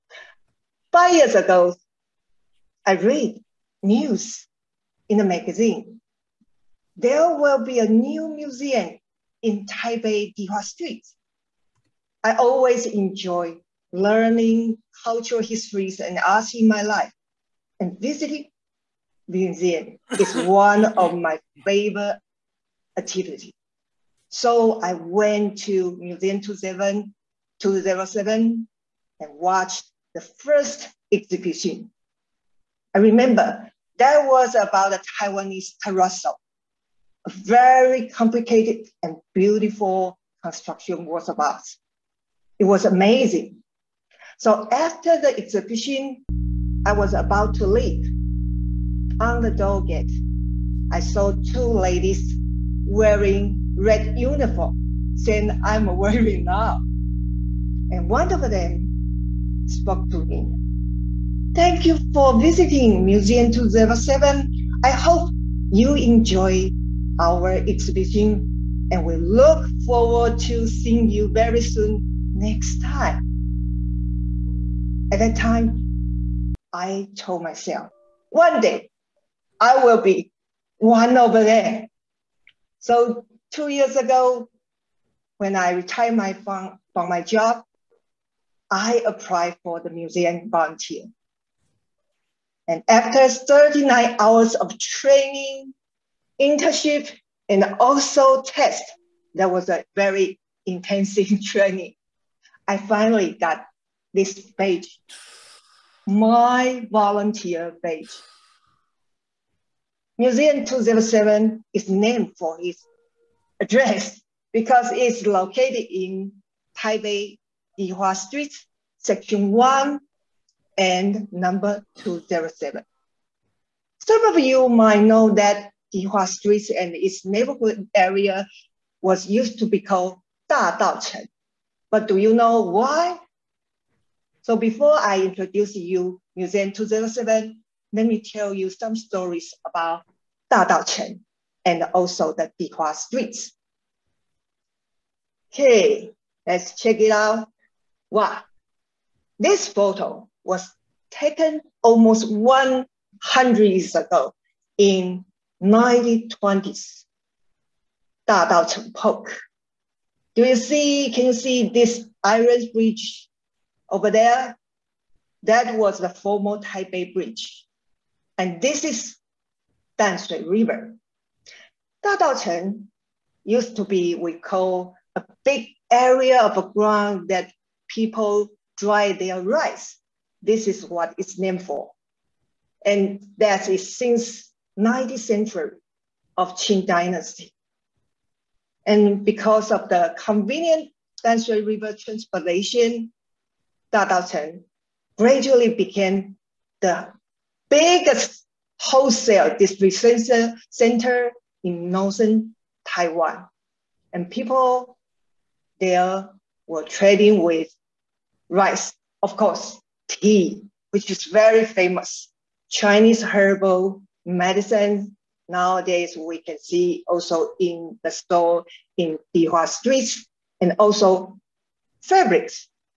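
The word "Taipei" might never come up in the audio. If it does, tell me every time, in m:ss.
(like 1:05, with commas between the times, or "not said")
0:09, 1:56, 2:46.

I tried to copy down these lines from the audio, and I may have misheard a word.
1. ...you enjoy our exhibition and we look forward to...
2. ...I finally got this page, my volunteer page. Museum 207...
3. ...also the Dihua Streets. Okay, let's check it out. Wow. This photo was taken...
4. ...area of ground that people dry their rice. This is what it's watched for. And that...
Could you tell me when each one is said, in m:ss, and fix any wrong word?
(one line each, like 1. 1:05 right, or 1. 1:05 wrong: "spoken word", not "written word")
1. 1:05 right
2. 1:42 right
3. 2:21 right
4. 2:55 wrong: "named", not "watched".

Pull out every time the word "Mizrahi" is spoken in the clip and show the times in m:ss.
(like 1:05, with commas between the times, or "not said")
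not said.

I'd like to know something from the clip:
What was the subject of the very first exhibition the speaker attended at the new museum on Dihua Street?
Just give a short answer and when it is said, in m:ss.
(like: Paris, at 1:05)
Taiwanese terrazzo, at 0:35.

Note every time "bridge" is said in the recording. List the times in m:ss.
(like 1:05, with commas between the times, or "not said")
2:42, 2:47.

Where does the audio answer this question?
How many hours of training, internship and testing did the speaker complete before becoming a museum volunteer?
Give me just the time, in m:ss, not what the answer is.
1:33.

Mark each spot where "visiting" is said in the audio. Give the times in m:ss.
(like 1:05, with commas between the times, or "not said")
0:17, 1:02.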